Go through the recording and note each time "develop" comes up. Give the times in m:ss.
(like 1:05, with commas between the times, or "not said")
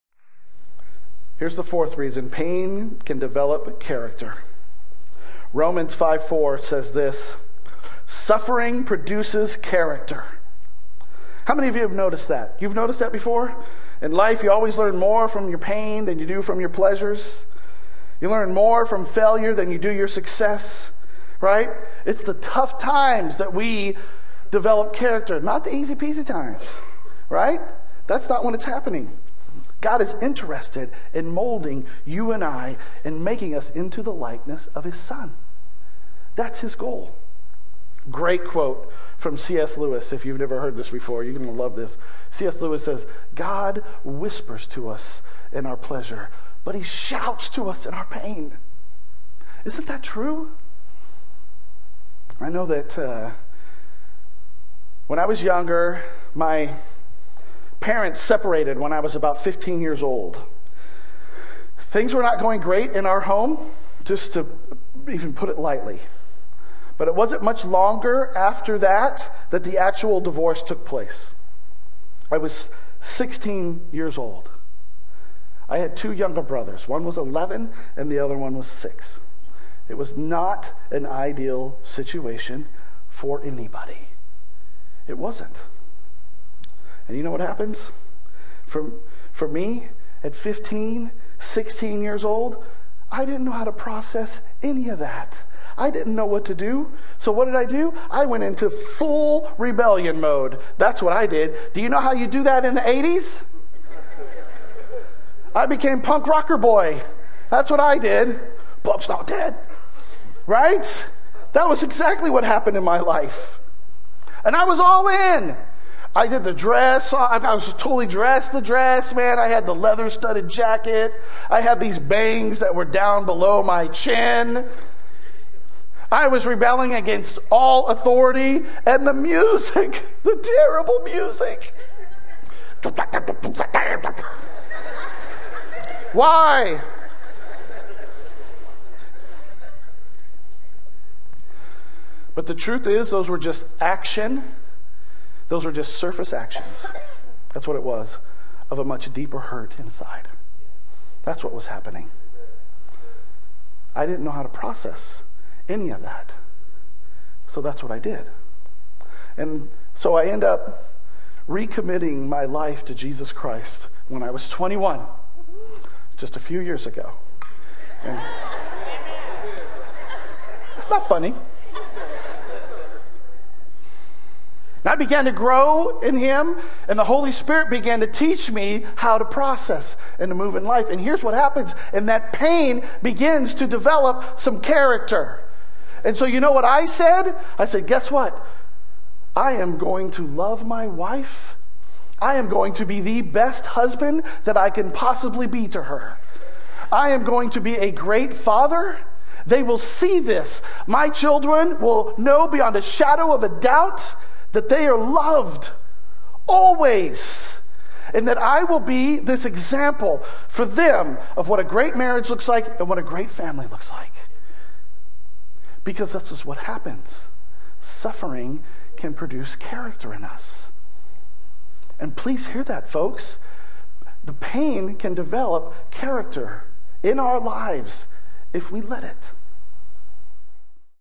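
0:03, 0:24, 3:03, 3:45.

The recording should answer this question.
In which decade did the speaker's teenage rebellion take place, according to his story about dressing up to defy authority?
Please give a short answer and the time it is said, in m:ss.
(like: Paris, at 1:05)
80s, at 1:42.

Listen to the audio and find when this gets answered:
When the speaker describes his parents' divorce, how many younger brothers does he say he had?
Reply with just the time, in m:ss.
1:15.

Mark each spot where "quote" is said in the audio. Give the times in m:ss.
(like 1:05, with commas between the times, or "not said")
0:38.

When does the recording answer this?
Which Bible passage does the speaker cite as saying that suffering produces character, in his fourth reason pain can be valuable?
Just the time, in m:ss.
0:05.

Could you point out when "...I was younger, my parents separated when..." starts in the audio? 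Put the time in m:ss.
0:55.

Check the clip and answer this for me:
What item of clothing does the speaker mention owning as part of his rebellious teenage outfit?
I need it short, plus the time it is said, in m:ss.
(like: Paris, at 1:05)
leather studded jacket, at 1:59.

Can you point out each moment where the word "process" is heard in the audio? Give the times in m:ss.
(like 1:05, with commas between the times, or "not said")
1:33, 2:34, 2:59.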